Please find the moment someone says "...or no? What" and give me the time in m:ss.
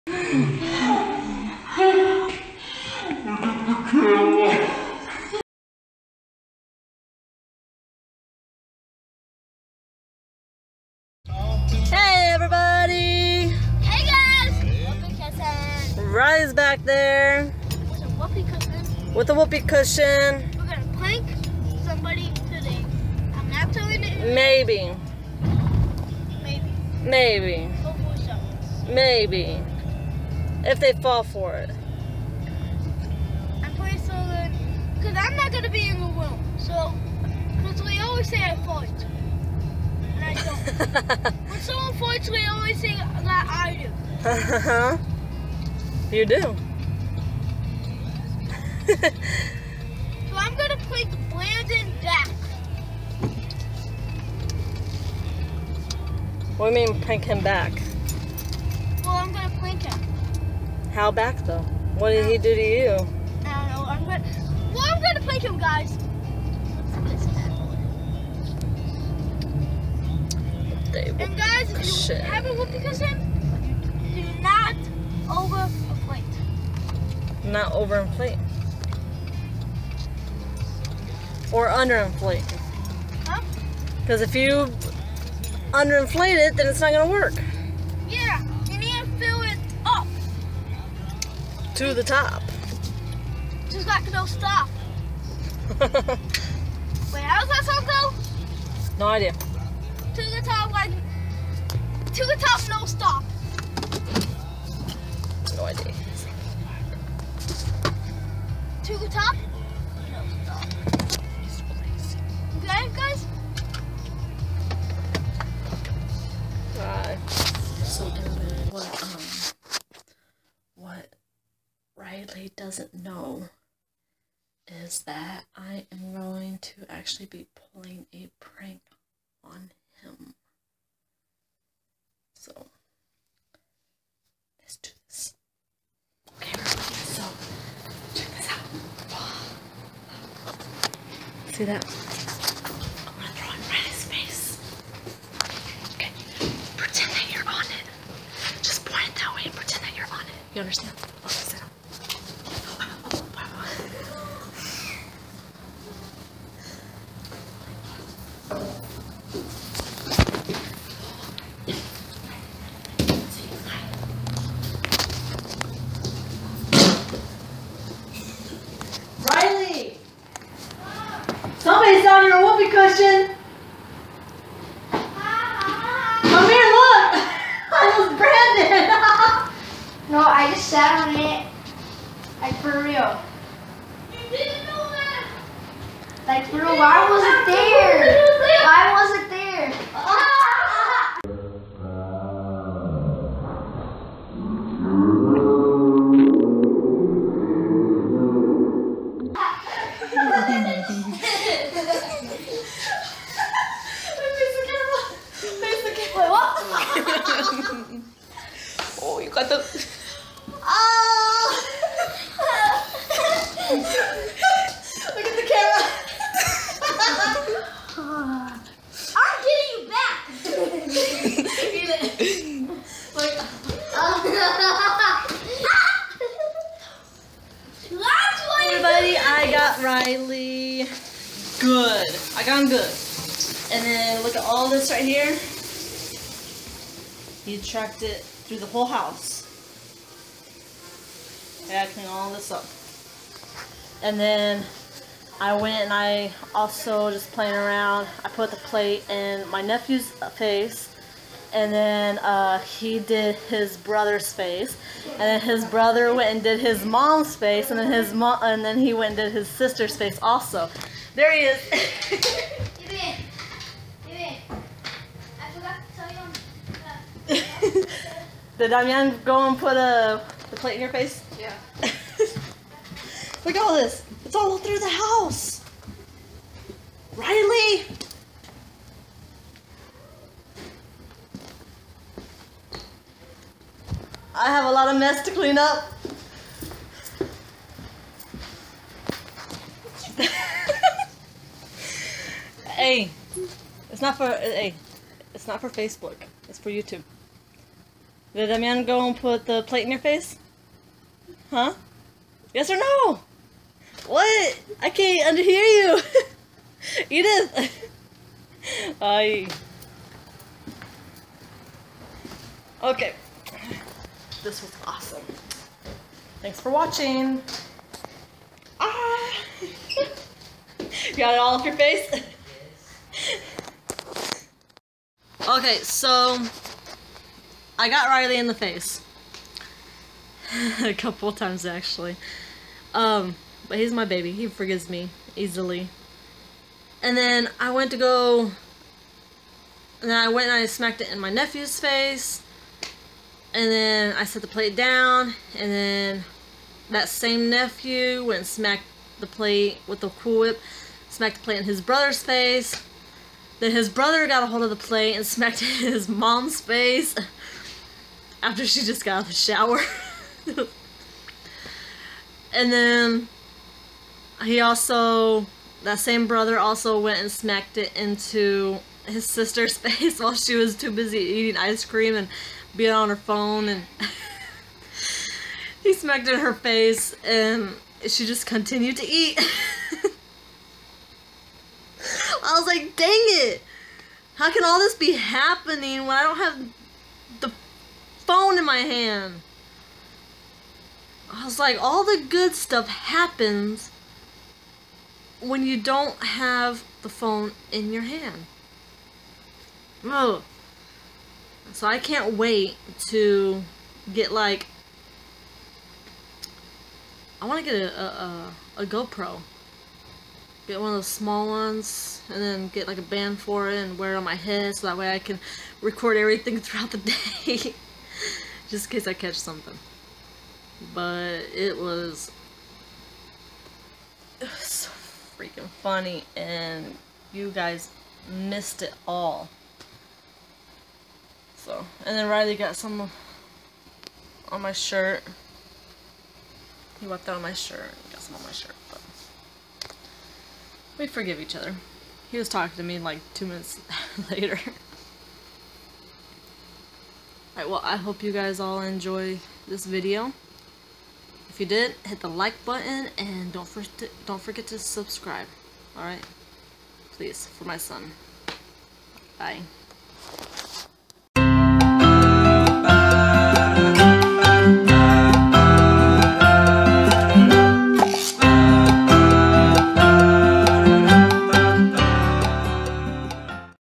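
5:02.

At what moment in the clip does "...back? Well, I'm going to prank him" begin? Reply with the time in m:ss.
0:57.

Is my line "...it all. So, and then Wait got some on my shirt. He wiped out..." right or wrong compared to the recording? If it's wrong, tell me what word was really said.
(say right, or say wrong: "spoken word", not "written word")
wrong: "Riley", not "Wait".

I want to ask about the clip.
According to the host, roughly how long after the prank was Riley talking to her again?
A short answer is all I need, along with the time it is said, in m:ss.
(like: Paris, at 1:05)
2 minutes, at 7:23.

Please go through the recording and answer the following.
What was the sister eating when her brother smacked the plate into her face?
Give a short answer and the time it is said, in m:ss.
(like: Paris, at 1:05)
Ice cream, at 6:11.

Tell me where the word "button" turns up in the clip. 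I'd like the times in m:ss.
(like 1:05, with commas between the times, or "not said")
7:32.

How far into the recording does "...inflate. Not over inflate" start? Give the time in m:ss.
1:15.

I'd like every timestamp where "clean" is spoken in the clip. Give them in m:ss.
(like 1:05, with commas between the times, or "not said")
4:01, 4:45.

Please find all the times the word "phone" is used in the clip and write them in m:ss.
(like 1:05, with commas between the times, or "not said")
6:13, 6:28, 6:37.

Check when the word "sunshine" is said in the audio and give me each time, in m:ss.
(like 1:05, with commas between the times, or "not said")
not said.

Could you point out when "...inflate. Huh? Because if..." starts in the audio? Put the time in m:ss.
1:21.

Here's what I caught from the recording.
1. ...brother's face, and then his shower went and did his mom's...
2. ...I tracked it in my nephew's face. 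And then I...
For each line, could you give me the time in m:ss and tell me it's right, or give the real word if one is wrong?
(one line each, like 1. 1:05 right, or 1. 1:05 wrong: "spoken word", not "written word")
1. 4:13 wrong: "brother", not "shower"
2. 5:40 wrong: "smacked", not "tracked".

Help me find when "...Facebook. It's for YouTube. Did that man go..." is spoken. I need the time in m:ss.
4:55.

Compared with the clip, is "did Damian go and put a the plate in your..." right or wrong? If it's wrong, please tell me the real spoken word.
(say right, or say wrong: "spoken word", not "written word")
right.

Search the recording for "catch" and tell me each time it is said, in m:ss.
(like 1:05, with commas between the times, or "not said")
6:59.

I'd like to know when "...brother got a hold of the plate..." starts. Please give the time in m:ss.
5:53.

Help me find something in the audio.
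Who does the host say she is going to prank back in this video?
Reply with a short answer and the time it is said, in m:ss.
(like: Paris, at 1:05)
Brandon, at 0:51.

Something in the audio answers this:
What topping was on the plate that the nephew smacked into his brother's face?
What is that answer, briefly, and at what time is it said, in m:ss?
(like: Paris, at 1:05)
Cool Whip, at 5:50.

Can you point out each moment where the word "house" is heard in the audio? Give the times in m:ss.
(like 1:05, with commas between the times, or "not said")
3:58, 4:34.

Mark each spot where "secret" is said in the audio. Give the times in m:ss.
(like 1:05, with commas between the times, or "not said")
not said.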